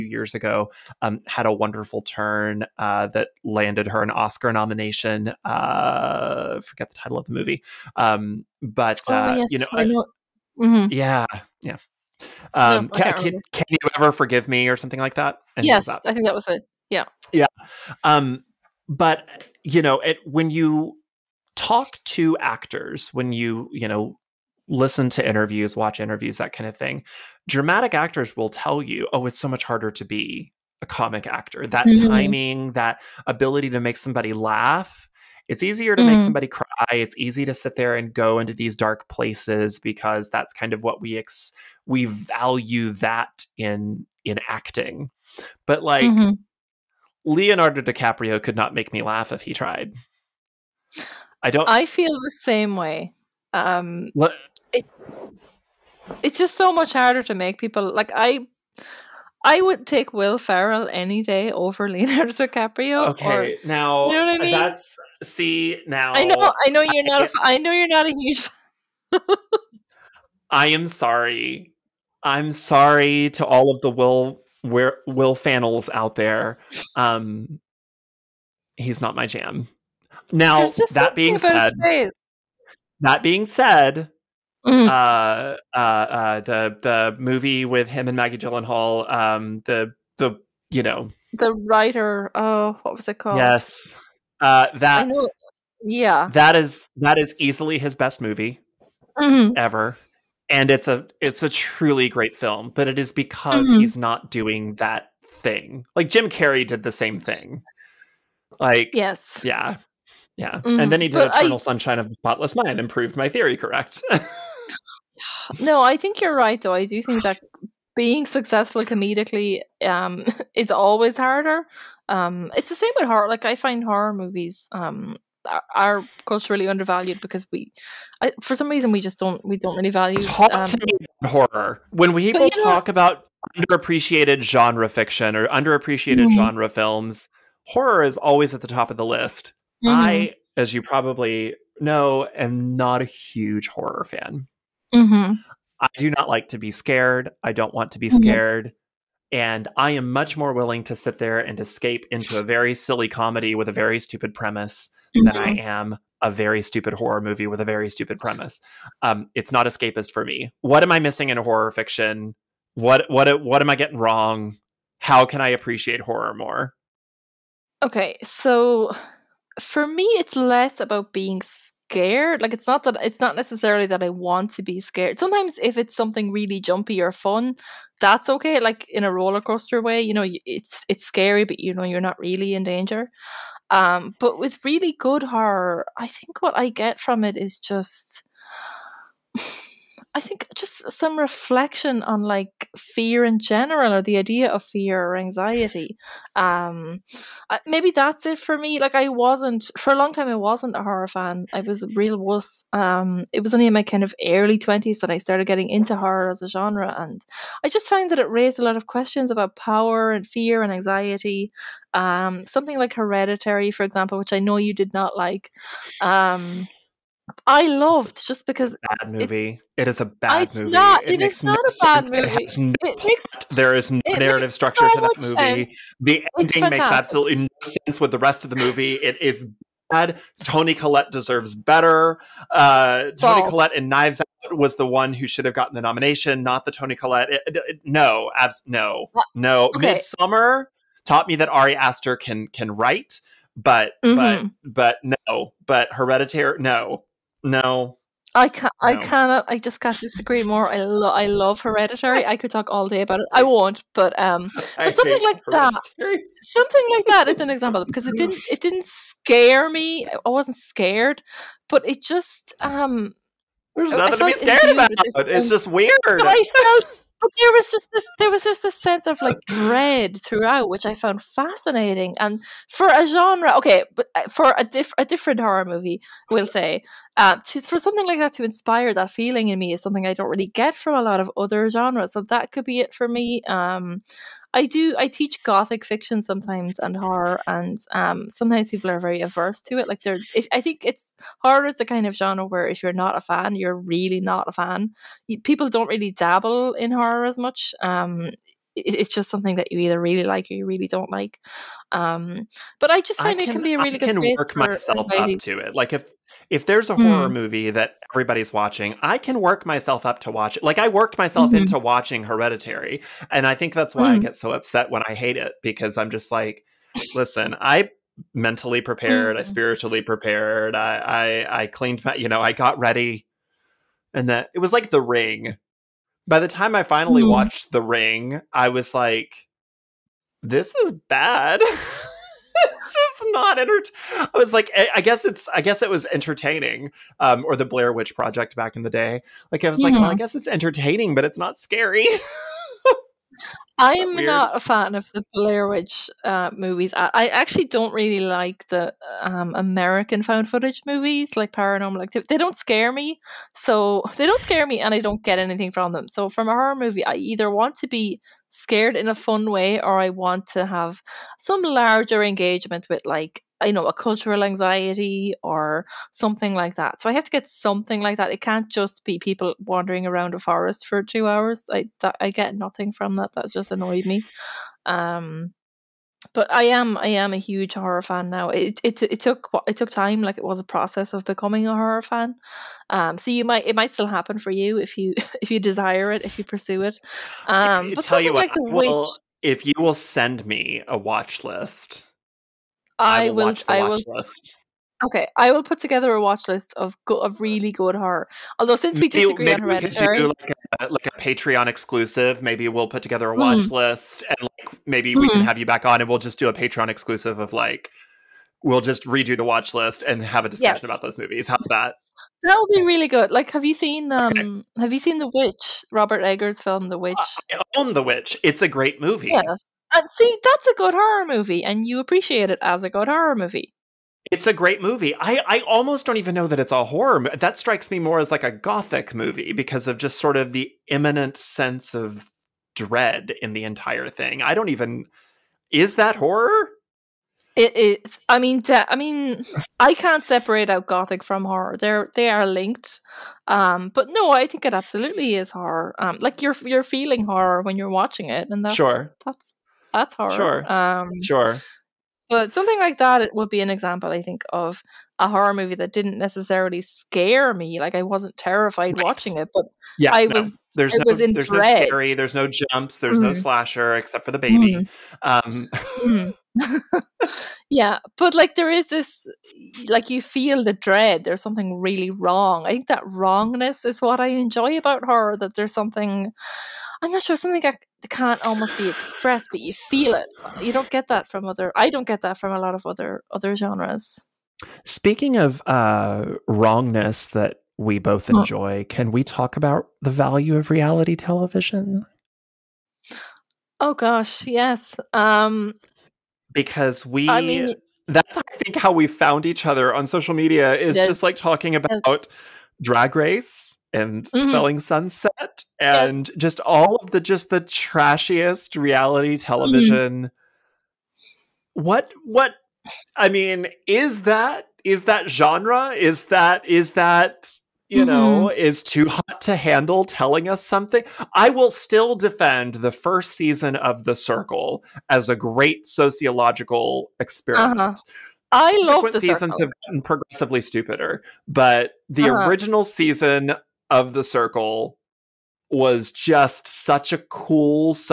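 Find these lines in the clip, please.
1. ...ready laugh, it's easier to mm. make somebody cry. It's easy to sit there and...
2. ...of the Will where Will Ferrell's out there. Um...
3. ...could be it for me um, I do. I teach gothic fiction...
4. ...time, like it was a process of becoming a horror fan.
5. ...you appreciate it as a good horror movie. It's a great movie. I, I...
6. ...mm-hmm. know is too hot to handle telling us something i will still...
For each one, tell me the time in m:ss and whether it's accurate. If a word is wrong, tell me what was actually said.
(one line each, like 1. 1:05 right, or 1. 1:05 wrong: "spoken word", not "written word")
1. 0:33 wrong: "somebody", not "ready"
2. 1:13 wrong: "Fannel", not "Ferrell"
3. 4:42 right
4. 6:19 right
5. 7:01 right
6. 8:37 right.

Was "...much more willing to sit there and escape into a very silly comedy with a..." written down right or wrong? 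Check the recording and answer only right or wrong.
right.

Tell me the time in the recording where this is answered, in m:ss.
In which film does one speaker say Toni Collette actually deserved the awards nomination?
3:53.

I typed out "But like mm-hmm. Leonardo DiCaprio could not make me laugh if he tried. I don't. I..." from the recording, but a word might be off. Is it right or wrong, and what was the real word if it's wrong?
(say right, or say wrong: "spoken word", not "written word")
right.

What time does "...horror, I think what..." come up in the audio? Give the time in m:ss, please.
3:05.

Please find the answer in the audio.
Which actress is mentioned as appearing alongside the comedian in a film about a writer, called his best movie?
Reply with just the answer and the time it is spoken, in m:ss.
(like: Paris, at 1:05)
Maggie Gyllenhaal, at 1:28.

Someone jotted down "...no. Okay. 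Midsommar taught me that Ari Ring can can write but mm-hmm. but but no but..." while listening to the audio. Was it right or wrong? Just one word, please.
wrong.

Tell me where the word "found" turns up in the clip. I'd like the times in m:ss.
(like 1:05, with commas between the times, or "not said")
3:27, 4:30, 5:50, 8:19.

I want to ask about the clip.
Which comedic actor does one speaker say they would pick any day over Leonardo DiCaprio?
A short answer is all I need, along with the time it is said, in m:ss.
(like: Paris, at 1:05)
Will Ferrell, at 1:00.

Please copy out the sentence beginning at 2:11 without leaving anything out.
When we know, talk about underappreciated genre fiction or underappreciated mm-hmm.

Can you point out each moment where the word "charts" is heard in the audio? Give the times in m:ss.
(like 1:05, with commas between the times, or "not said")
not said.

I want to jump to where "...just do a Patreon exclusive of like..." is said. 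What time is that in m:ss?
6:46.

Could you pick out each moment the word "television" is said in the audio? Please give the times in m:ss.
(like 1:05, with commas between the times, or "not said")
8:11, 8:29.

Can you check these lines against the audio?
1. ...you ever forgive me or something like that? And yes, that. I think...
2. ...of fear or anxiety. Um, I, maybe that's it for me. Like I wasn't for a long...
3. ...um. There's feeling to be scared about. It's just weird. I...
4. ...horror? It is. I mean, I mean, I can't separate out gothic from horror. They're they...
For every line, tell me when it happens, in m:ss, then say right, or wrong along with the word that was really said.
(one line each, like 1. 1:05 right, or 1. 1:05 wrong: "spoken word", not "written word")
1. 0:13 right
2. 3:14 right
3. 4:22 wrong: "nothing", not "feeling"
4. 7:16 right.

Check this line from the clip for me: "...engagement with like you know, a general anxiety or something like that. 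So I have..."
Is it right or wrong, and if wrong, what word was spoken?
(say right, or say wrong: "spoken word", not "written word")
wrong: "cultural", not "general".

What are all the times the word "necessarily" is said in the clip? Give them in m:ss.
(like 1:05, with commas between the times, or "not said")
2:53, 7:36.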